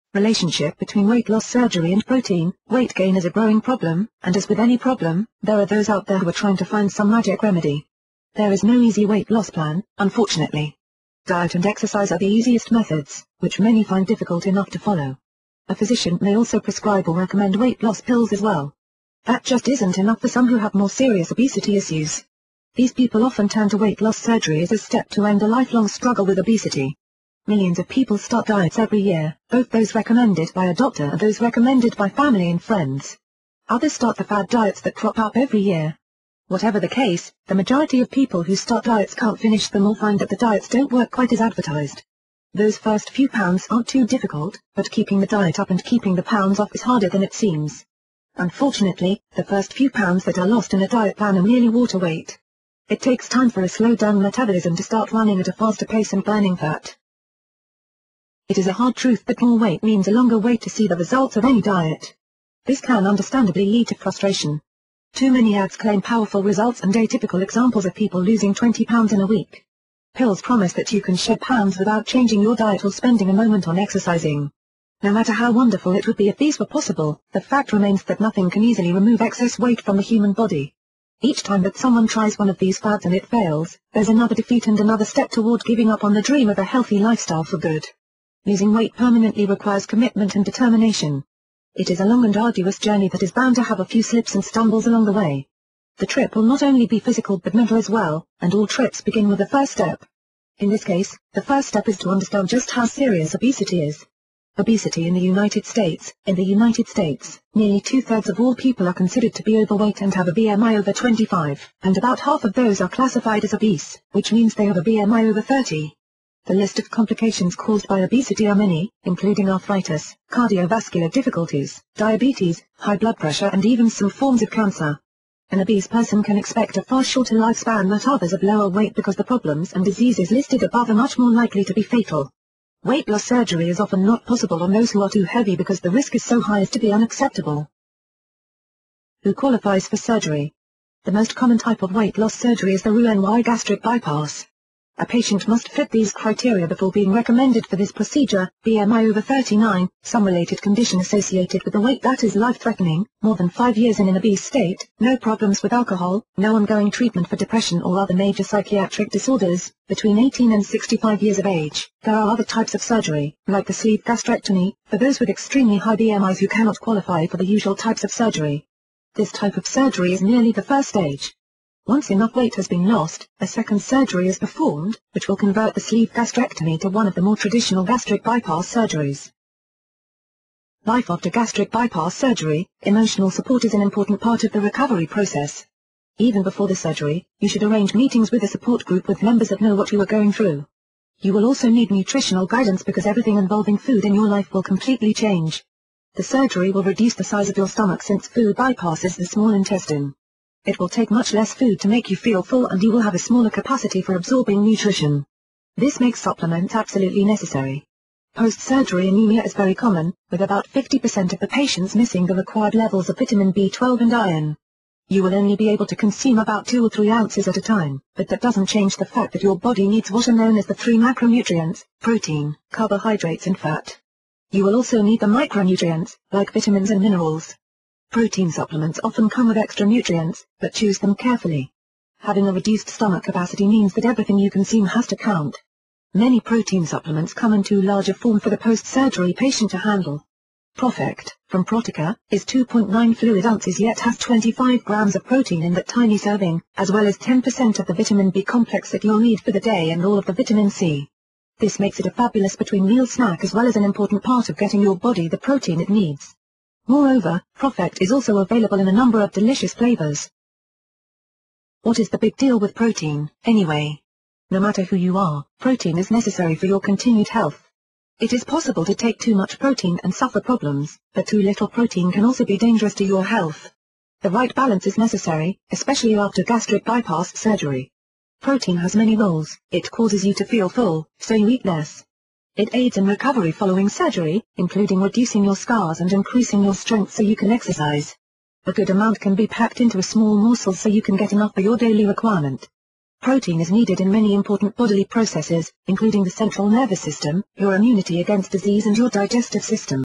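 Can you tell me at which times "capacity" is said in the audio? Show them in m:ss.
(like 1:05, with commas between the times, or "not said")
3:23, 3:53.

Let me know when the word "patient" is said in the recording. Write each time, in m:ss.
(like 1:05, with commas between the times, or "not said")
2:25, 3:31, 3:59.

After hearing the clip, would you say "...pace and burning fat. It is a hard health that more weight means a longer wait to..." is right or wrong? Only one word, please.
wrong.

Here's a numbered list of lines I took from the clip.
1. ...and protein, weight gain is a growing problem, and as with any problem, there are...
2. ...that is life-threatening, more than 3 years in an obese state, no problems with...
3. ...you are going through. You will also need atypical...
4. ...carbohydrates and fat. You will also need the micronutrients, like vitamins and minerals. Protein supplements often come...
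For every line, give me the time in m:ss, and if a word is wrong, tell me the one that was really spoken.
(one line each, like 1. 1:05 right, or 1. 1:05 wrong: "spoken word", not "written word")
1. 0:01 right
2. 2:32 wrong: "5", not "3"
3. 3:09 wrong: "nutritional", not "atypical"
4. 3:42 right.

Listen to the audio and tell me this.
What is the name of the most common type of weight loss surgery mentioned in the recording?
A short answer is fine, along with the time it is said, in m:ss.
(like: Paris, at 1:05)
Roux-en-Y gastric bypass, at 2:22.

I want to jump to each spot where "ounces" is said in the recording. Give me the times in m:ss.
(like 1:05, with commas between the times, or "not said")
3:37, 4:03.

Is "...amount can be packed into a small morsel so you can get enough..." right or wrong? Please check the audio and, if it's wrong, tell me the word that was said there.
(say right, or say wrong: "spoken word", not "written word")
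right.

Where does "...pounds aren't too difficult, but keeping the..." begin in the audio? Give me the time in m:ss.
0:43.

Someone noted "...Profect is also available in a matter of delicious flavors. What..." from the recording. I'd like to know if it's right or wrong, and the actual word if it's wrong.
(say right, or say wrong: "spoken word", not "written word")
wrong: "number", not "matter".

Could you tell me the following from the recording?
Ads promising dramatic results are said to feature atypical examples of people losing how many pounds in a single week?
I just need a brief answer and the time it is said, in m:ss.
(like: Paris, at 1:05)
20, at 1:08.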